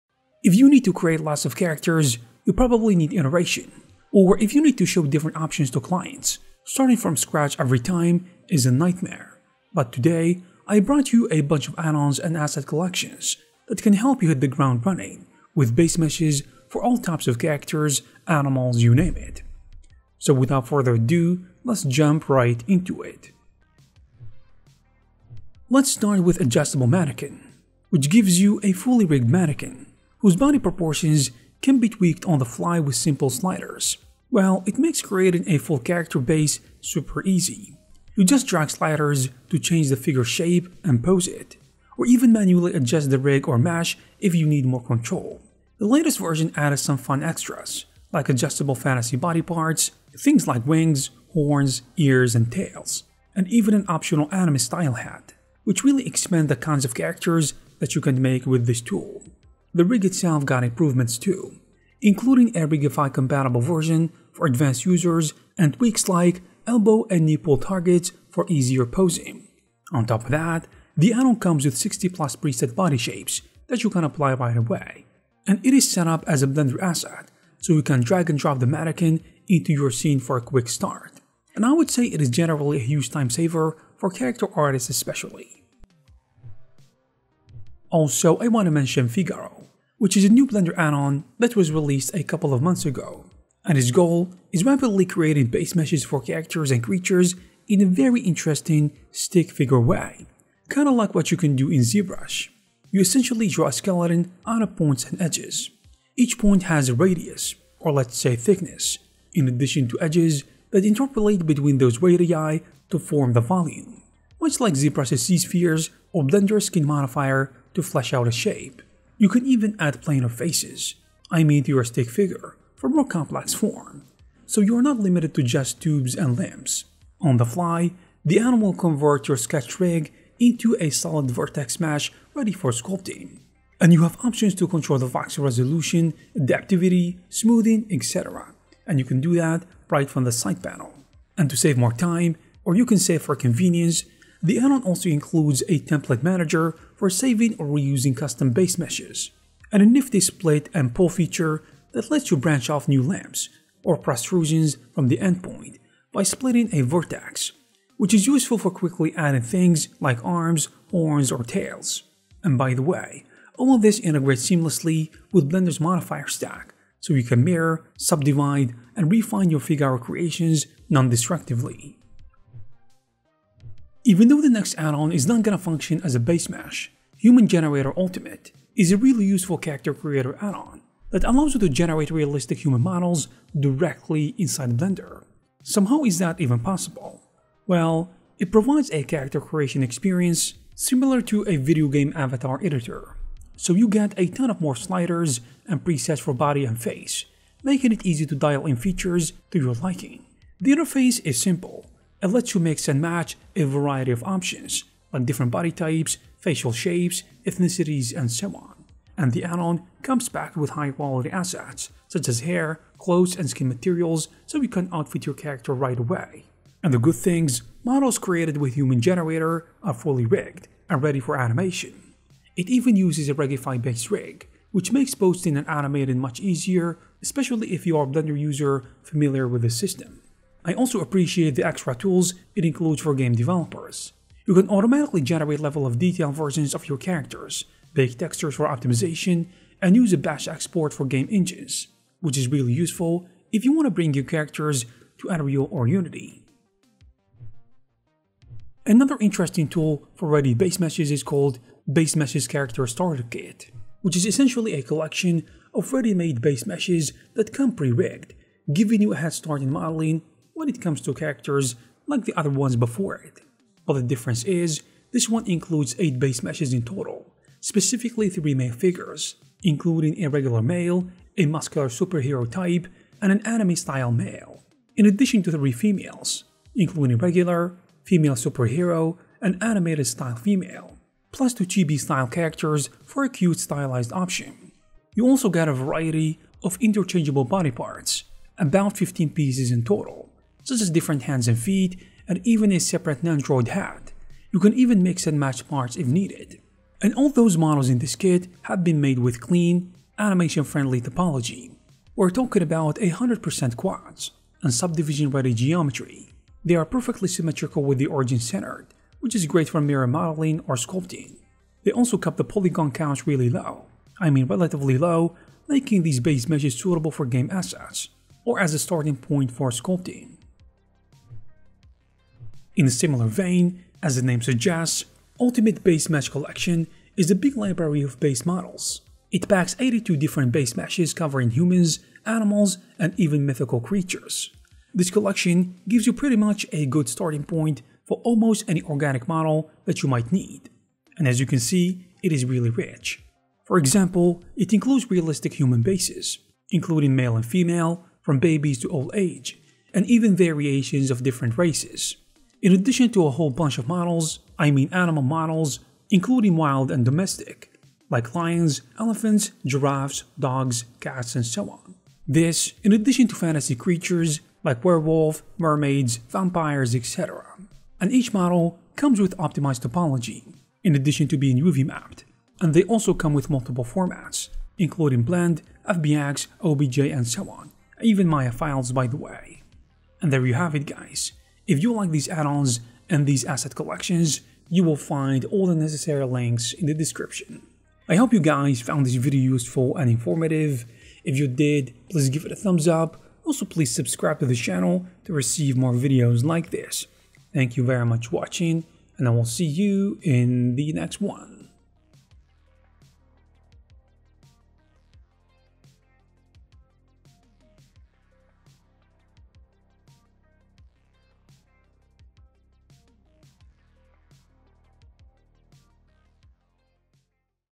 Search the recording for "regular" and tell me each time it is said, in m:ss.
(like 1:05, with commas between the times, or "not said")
4:30, 4:37.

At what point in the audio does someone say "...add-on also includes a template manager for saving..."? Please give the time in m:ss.
2:24.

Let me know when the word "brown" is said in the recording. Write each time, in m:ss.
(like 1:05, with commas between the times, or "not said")
not said.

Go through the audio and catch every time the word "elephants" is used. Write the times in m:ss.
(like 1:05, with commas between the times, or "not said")
5:58.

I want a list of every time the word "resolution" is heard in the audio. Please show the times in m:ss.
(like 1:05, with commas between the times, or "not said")
2:15.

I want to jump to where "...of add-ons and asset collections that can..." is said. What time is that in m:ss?
0:11.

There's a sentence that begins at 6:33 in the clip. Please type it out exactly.
Also, please subscribe to the channel to receive more videos like this.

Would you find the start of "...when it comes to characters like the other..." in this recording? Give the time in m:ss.
4:20.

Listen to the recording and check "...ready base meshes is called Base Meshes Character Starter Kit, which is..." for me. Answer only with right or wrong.
right.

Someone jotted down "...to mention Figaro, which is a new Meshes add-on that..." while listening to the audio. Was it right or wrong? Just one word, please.
wrong.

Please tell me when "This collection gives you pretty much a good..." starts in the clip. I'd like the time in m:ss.
5:34.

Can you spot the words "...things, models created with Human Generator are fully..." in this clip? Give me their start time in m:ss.
3:37.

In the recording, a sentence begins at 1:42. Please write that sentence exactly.
You essentially draw a skeleton out of points and edges.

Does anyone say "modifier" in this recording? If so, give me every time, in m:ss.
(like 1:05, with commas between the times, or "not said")
1:56, 2:45.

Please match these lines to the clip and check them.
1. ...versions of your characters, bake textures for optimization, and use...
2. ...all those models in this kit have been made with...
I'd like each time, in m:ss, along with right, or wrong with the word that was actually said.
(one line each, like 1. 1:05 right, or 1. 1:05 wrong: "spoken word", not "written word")
1. 3:56 right
2. 4:57 right.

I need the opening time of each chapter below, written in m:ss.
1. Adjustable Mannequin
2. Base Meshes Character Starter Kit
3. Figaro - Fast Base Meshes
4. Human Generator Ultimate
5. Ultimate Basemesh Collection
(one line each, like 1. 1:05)
1. 0:24
2. 4:07
3. 1:26
4. 2:52
5. 5:21.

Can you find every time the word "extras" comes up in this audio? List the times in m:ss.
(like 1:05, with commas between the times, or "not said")
0:47, 3:51.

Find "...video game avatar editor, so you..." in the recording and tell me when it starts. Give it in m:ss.
3:11.